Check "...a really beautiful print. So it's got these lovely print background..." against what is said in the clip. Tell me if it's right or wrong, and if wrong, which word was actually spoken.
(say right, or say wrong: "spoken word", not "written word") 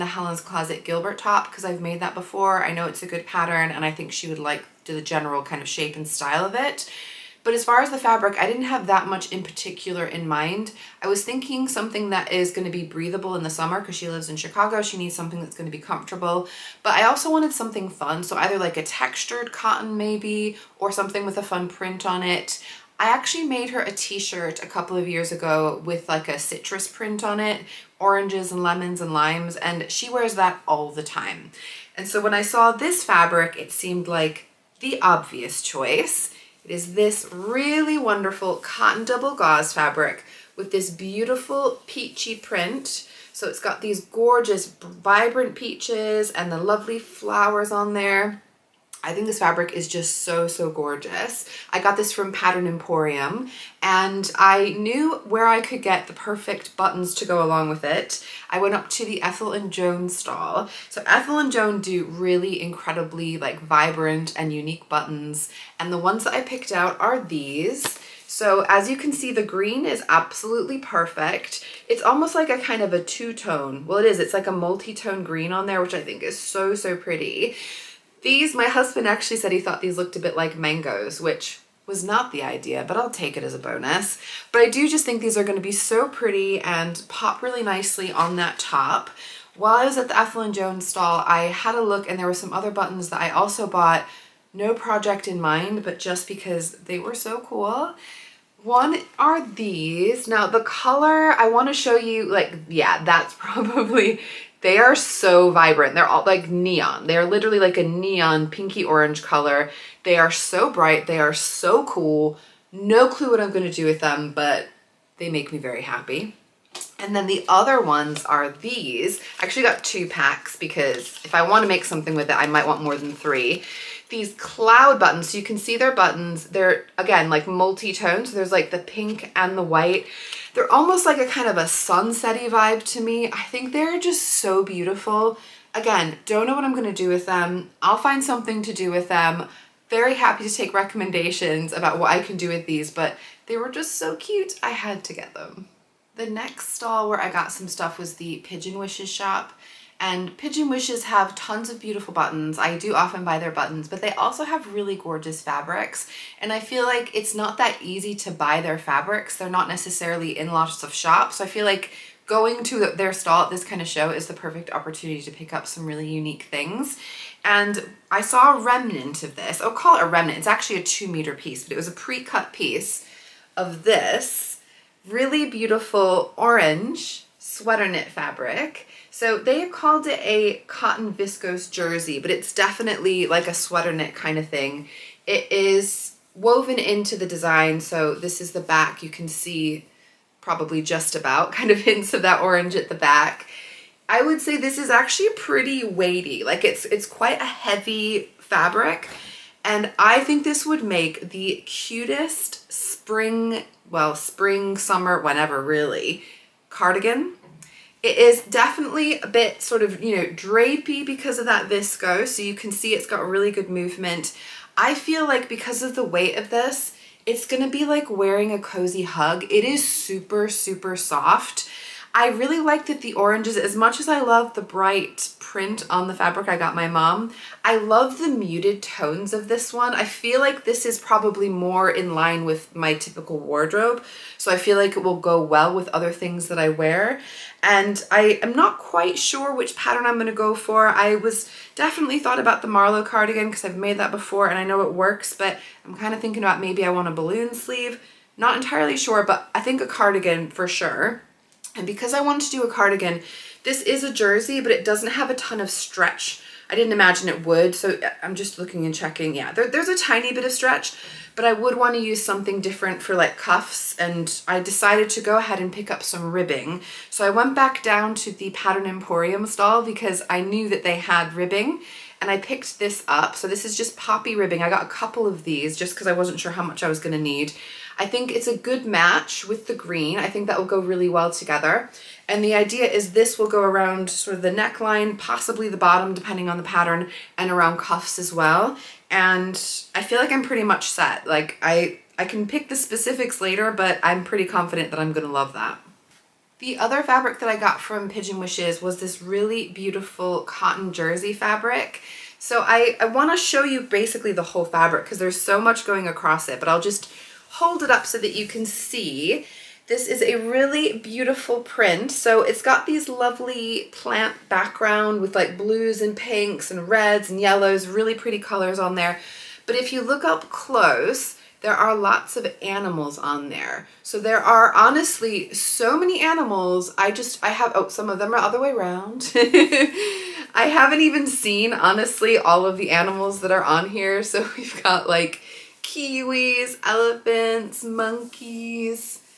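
wrong: "plant", not "print".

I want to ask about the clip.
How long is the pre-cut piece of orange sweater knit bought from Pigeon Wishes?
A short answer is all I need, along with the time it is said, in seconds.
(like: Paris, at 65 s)
2 meters, at 170 s.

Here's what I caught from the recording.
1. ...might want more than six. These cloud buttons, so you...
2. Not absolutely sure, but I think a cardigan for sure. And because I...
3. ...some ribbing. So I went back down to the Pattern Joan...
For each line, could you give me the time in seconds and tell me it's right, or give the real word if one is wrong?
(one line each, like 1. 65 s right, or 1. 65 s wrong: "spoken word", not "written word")
1. 122 s wrong: "three", not "six"
2. 248 s wrong: "entirely", not "absolutely"
3. 266 s wrong: "Emporium", not "Joan".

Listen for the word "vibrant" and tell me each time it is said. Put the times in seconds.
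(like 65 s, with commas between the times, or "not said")
44 s, 63 s, 105 s.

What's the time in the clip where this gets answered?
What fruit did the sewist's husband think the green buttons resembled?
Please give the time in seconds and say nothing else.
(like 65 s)
80 s.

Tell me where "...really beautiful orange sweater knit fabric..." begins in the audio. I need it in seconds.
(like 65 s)
175 s.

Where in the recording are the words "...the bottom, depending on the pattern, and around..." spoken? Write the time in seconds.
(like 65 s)
285 s.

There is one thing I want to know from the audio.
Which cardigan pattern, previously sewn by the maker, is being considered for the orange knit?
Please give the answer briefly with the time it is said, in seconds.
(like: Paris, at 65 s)
Marlo cardigan, at 242 s.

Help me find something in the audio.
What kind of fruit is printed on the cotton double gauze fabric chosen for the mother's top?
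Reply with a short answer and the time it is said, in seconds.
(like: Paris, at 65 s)
Peaches, at 45 s.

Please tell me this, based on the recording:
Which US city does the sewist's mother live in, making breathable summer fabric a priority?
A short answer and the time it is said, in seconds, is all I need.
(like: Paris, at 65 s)
Chicago, at 14 s.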